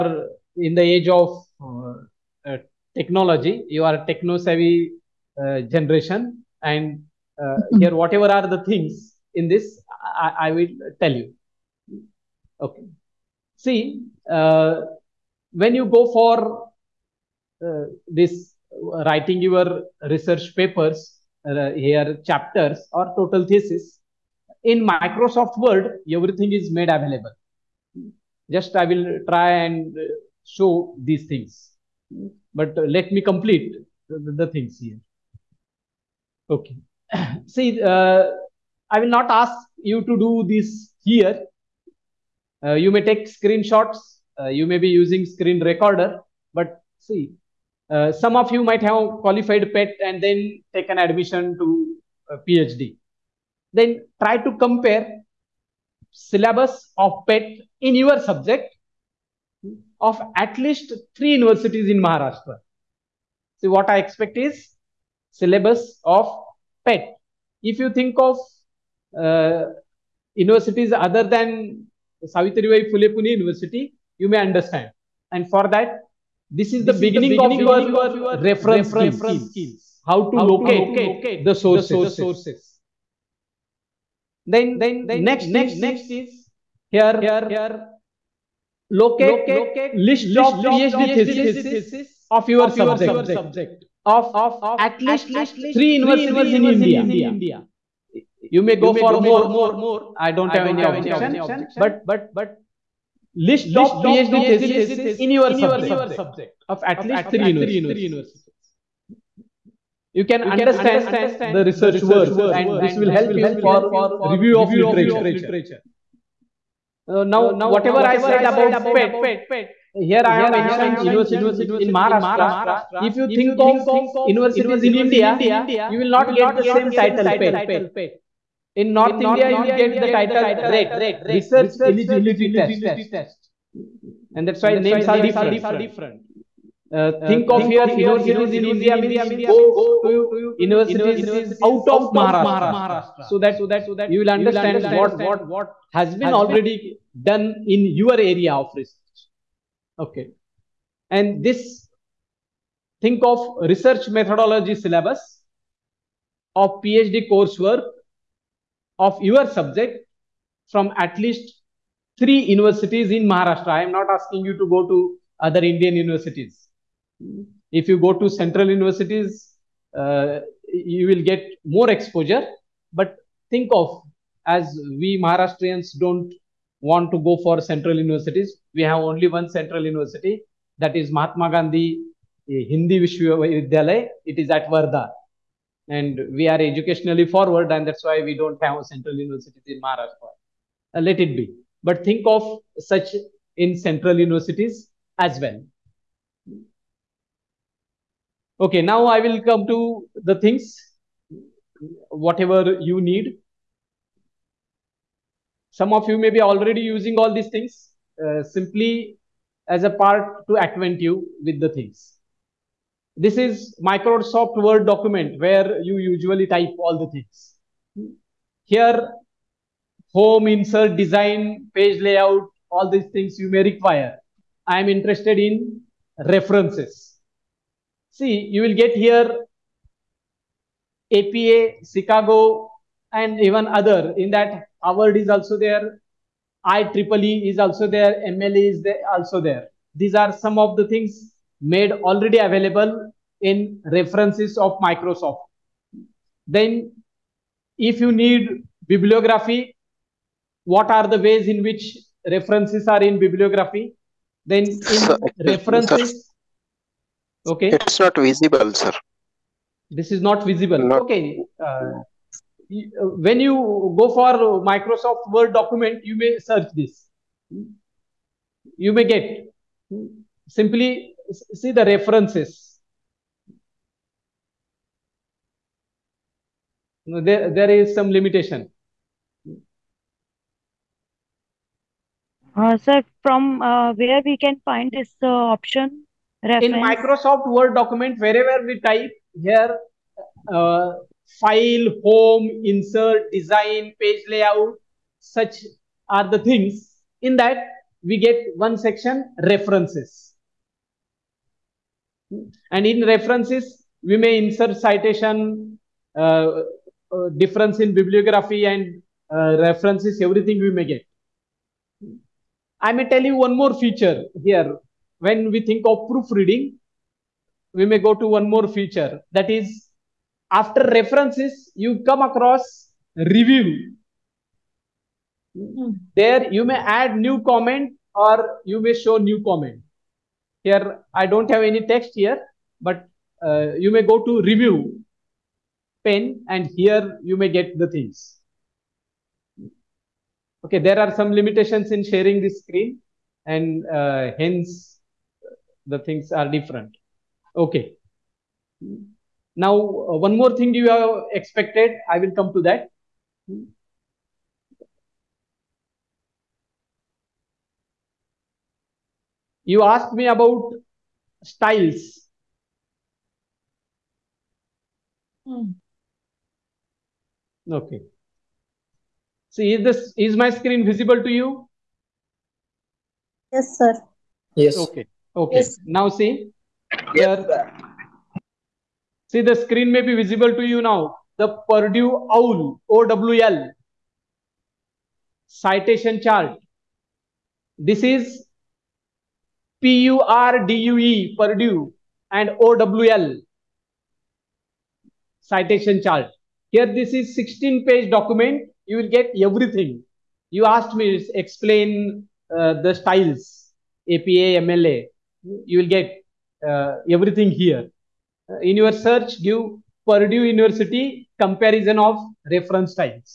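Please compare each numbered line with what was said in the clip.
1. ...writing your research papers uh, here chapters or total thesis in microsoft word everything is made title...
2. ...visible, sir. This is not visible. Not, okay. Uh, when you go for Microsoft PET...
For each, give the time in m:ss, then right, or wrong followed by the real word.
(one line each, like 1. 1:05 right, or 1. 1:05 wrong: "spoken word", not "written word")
1. 0:19 wrong: "available", not "title"
2. 4:18 wrong: "Word", not "PET".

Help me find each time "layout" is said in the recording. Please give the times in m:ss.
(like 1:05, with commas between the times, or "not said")
3:42, 4:54.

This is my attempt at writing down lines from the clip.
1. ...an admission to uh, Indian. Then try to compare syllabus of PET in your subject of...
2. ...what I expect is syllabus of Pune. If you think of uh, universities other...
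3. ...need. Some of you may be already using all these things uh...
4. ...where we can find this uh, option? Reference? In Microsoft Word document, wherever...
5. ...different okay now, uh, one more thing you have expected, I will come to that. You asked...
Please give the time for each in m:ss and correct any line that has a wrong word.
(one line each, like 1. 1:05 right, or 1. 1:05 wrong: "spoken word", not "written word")
1. 0:50 wrong: "PhD", not "Indian"
2. 1:03 wrong: "PET", not "Pune"
3. 3:23 right
4. 4:43 right
5. 5:46 right.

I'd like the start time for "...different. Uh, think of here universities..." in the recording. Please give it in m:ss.
2:15.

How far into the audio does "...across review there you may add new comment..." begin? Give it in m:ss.
5:22.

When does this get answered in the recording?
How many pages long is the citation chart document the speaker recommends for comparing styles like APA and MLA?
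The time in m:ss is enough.
6:37.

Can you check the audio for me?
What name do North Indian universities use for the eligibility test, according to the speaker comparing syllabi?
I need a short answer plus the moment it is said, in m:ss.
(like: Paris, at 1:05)
Research Eligibility Test, at 2:11.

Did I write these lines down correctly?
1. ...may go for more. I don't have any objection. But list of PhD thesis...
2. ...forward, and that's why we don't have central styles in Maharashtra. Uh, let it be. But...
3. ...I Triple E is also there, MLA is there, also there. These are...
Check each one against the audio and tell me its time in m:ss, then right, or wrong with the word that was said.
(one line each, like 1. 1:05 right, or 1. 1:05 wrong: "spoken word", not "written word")
1. 1:38 right
2. 3:07 wrong: "universities", not "styles"
3. 3:56 right.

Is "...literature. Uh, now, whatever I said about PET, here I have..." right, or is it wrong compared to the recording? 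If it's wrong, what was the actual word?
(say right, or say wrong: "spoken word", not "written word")
right.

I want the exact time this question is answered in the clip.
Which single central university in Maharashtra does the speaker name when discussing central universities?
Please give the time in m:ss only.
3:01.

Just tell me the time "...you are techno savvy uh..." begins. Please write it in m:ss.
0:03.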